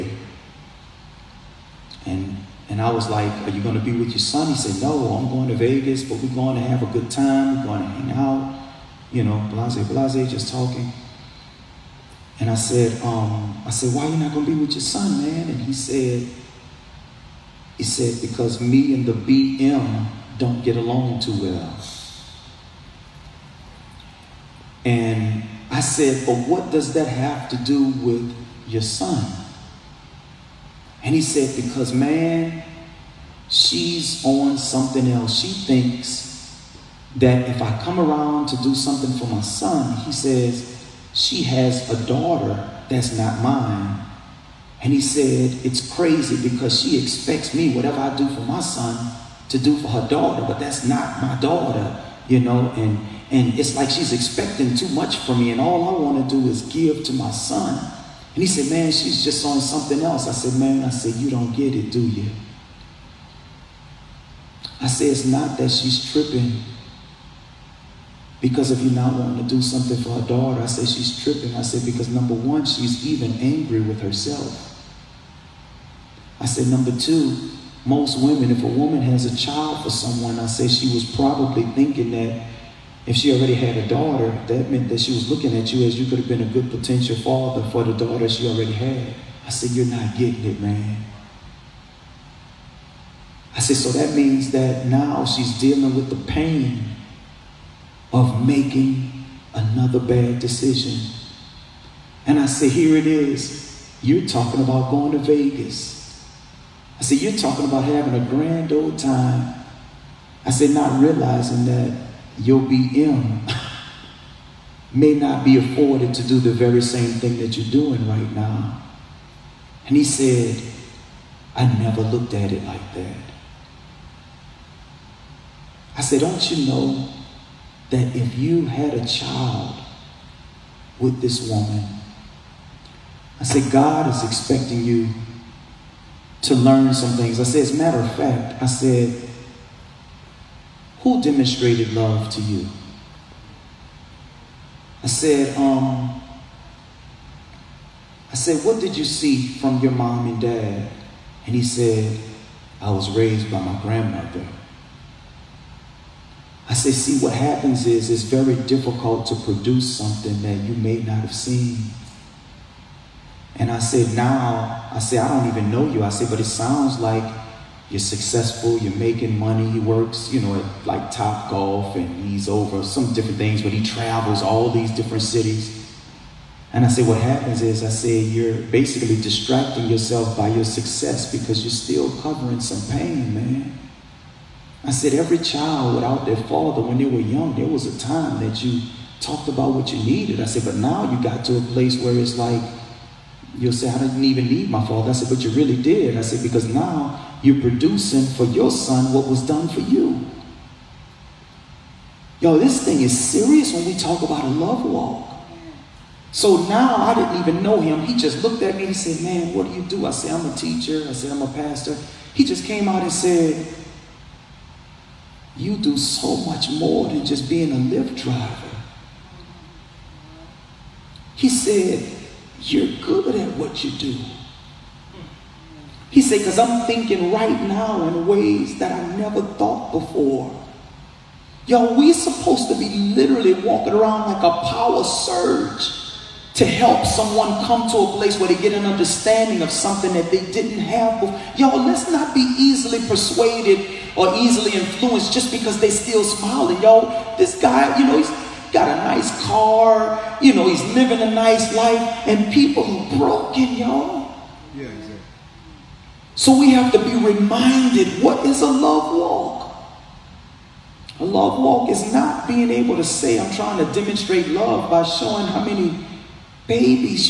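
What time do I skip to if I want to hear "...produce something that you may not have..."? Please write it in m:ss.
2:39.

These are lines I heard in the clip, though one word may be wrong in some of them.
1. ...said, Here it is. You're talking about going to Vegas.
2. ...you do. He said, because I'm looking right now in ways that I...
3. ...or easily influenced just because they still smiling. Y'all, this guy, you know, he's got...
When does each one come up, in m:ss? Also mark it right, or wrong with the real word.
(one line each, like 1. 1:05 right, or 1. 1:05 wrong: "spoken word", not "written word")
1. 1:42 right
2. 3:43 wrong: "thinking", not "looking"
3. 4:04 right.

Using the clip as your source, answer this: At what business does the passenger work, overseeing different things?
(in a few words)
Top Golf.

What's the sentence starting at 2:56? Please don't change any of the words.
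And I say, what happens is, I say, you're basically distracting yourself by your success because you're still covering some pain, man.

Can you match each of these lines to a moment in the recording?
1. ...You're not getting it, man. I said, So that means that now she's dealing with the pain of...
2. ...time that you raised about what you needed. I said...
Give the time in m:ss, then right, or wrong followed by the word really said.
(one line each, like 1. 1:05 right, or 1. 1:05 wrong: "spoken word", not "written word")
1. 1:29 right
2. 3:07 wrong: "talked", not "raised".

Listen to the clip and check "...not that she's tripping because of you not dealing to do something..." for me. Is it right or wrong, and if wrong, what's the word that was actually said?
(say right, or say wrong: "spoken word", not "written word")
wrong: "wanting", not "dealing".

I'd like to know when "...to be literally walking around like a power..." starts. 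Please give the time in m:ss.
3:52.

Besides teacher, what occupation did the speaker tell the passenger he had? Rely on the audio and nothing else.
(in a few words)
Pastor.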